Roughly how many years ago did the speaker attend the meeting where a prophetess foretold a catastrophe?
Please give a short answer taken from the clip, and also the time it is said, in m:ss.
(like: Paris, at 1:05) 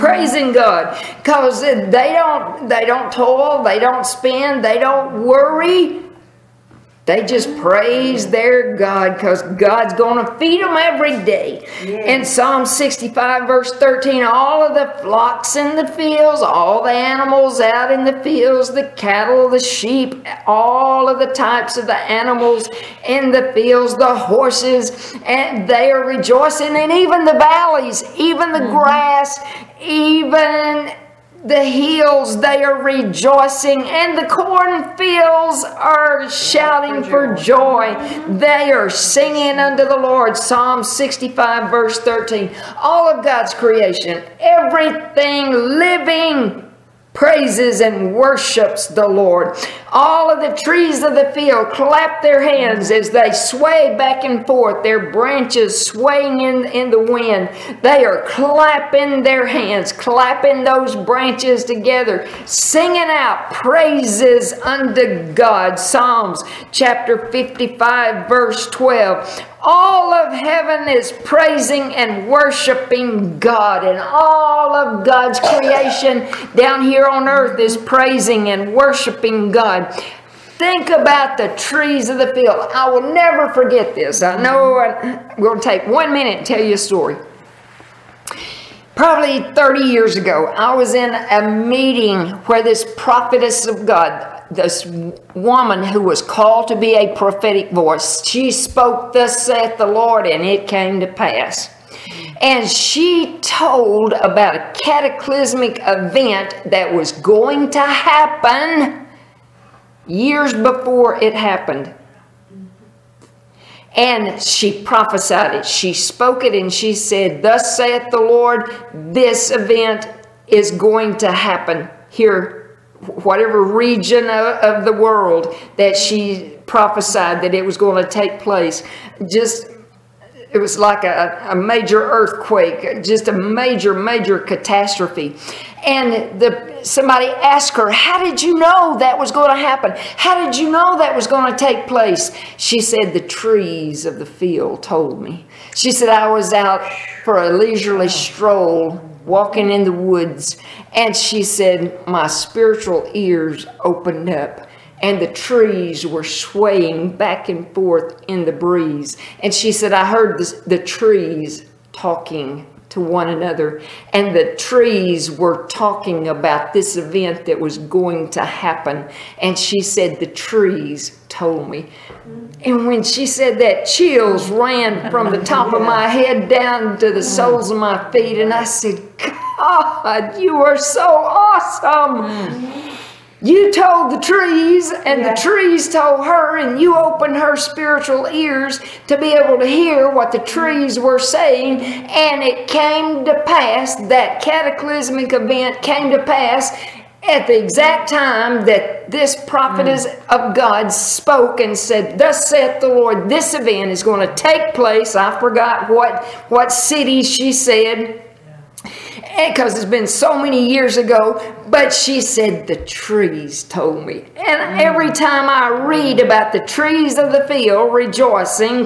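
30 years, at 1:29.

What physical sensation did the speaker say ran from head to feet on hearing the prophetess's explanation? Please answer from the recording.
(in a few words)
Chills.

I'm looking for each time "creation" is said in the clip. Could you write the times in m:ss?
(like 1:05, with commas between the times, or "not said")
0:43, 1:15.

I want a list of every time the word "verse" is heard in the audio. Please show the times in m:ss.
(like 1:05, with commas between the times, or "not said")
0:13, 0:41, 1:08.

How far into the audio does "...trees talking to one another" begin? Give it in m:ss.
2:40.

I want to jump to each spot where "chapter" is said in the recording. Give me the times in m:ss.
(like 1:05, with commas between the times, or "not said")
1:06.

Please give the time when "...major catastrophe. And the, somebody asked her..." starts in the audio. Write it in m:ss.
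2:13.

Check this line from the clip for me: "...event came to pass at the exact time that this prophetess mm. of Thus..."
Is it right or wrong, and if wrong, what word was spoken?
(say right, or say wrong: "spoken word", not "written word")
wrong: "God", not "Thus".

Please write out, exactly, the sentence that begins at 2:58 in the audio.
And I said, God, you are so awesome.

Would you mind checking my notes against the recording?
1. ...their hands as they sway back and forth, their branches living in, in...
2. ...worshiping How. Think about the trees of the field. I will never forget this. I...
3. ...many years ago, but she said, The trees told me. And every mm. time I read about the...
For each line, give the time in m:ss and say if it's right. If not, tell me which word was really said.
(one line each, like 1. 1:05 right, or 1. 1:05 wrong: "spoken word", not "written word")
1. 0:52 wrong: "swaying", not "living"
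2. 1:18 wrong: "God", not "How"
3. 3:30 right.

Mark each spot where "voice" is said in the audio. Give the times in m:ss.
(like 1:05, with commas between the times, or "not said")
1:37.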